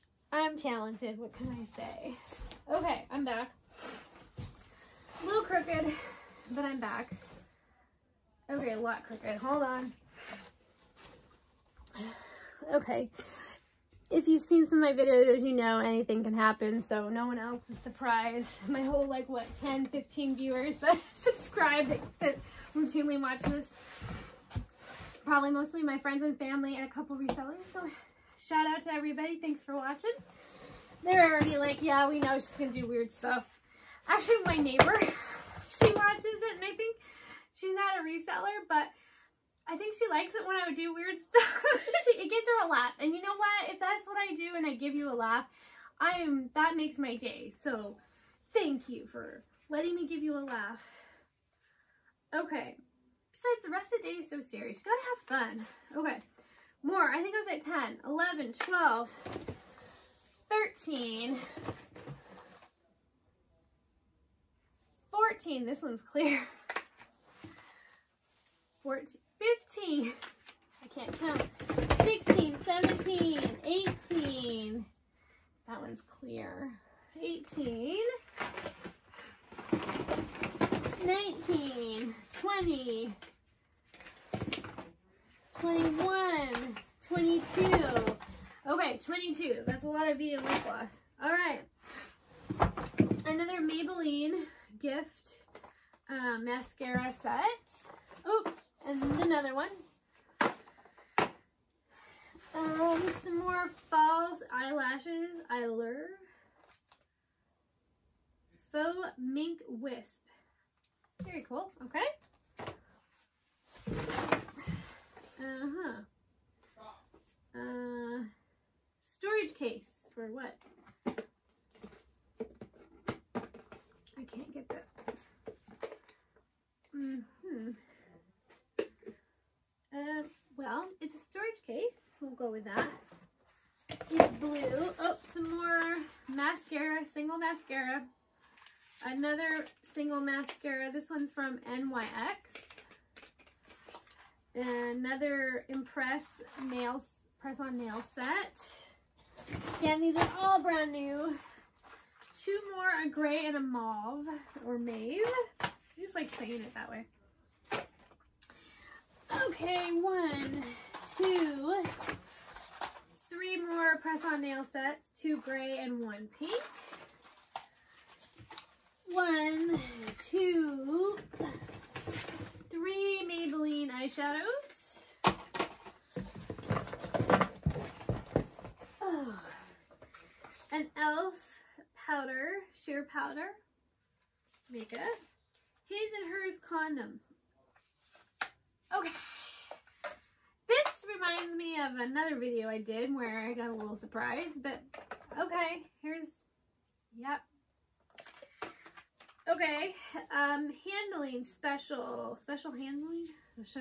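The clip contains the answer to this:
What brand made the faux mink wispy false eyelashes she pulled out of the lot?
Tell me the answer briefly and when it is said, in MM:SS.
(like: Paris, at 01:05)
Eyelure, at 01:45.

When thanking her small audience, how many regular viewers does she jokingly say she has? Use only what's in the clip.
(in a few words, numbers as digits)
10 to 15.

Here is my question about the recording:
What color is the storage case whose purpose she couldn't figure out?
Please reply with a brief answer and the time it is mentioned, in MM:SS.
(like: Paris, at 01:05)
Blue, at 02:14.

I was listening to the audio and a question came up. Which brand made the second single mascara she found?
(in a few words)
NYX.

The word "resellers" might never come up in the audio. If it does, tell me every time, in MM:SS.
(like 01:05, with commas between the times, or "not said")
00:27, 00:38.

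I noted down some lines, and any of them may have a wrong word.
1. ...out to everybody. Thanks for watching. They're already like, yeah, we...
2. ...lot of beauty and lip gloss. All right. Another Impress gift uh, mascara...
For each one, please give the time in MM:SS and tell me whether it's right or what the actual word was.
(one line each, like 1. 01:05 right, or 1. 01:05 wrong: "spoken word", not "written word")
1. 00:28 right
2. 01:29 wrong: "Maybelline", not "Impress".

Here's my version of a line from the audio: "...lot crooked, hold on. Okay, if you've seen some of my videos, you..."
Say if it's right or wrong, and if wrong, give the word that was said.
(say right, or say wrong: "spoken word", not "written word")
right.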